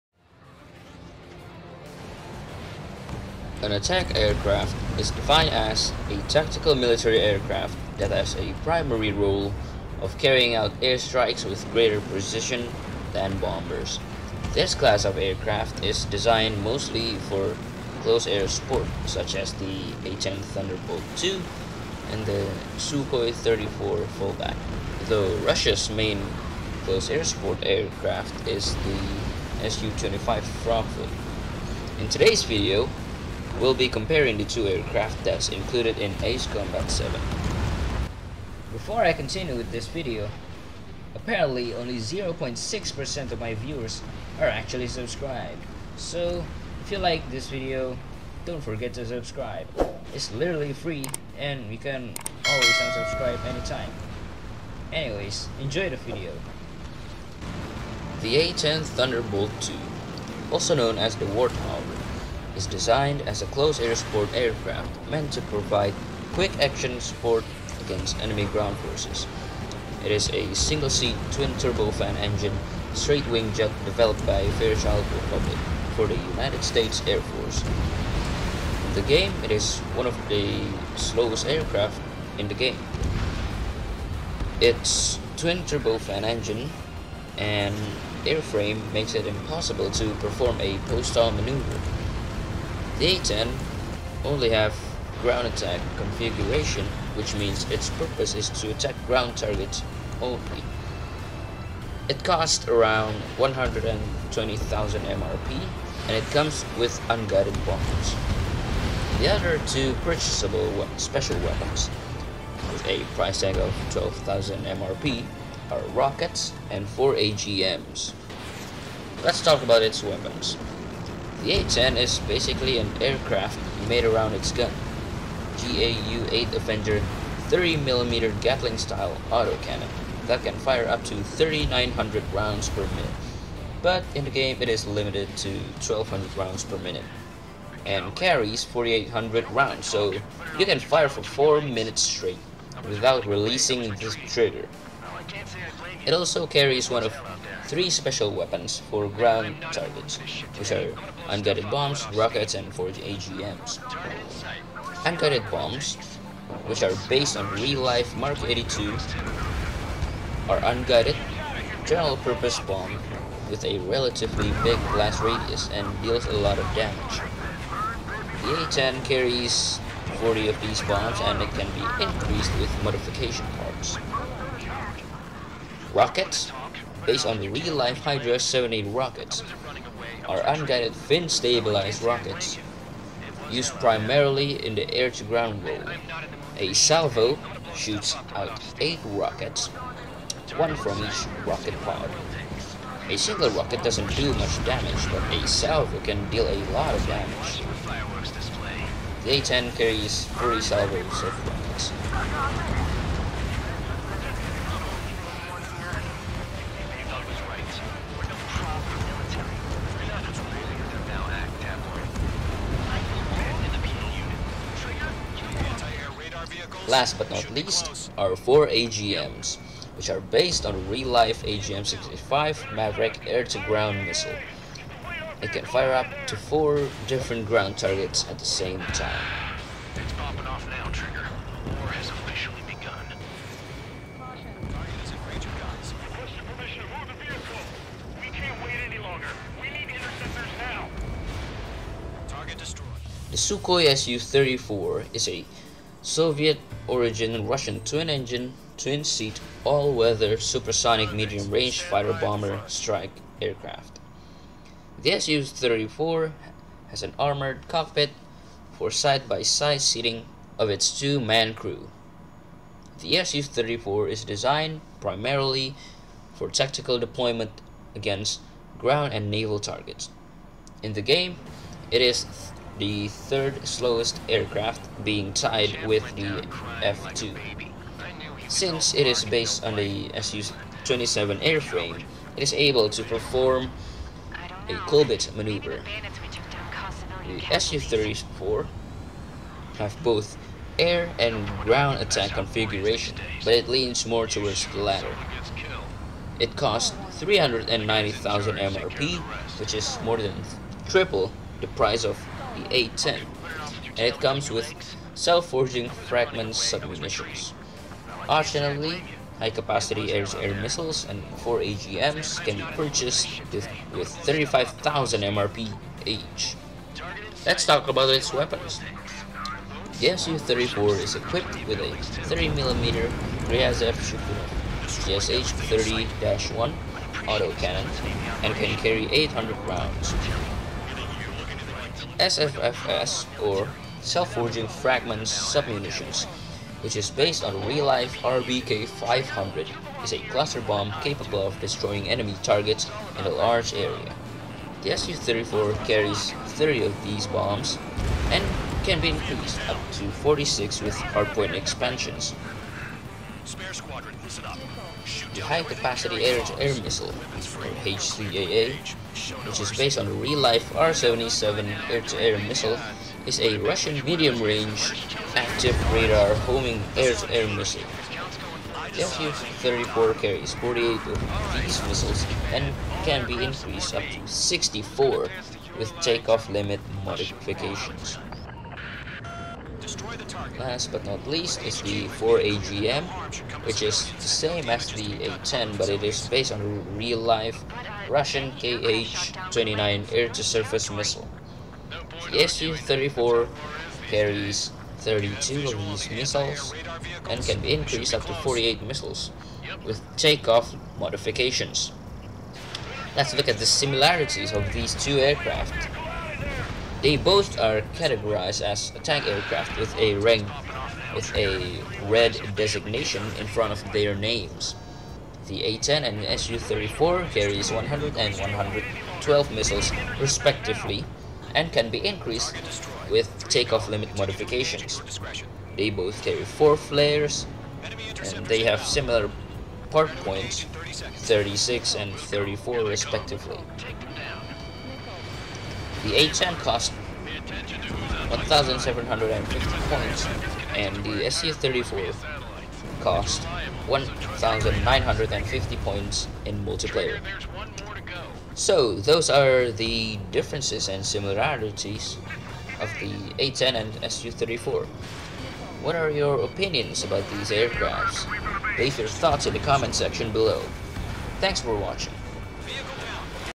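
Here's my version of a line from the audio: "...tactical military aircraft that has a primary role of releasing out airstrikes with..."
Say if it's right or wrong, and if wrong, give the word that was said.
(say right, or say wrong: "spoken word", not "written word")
wrong: "carrying", not "releasing".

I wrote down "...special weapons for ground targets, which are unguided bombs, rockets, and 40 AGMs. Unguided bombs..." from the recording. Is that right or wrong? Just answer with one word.
right.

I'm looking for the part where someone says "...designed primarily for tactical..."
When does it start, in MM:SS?
04:24.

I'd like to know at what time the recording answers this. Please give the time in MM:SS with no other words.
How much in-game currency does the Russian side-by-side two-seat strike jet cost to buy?
04:57.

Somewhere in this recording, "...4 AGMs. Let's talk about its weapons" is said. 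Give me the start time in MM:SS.
01:56.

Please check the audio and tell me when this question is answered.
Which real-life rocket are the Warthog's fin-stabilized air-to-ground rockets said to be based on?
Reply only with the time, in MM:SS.
02:57.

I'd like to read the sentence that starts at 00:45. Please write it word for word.
So, if you like this video, don't forget to subscribe.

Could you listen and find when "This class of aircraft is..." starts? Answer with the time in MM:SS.
00:14.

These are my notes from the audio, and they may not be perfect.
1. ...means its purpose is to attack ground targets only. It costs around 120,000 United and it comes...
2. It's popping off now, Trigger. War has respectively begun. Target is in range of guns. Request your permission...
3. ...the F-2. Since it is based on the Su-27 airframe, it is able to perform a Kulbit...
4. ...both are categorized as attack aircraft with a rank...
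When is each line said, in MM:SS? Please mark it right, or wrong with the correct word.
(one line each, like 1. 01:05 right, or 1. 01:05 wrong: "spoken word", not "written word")
1. 01:37 wrong: "MRP", not "United"
2. 03:49 wrong: "officially", not "respectively"
3. 04:36 right
4. 06:47 right.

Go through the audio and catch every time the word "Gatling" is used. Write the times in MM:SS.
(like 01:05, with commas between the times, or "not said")
02:08.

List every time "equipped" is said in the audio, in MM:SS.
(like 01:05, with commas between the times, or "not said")
05:21.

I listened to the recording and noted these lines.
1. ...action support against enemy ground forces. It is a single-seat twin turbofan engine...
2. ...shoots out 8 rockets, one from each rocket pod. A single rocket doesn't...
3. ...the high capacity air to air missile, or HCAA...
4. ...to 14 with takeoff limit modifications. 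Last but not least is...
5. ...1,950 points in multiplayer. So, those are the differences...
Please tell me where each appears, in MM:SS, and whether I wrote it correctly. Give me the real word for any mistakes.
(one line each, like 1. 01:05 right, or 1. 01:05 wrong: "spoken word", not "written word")
1. 01:06 right
2. 03:07 right
3. 05:55 right
4. 06:14 wrong: "64", not "14"
5. 07:23 right.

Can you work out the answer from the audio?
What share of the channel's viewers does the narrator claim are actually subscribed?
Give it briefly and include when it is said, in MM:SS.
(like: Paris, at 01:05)
0.6%, at 00:41.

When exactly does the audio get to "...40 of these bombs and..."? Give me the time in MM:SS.
02:50.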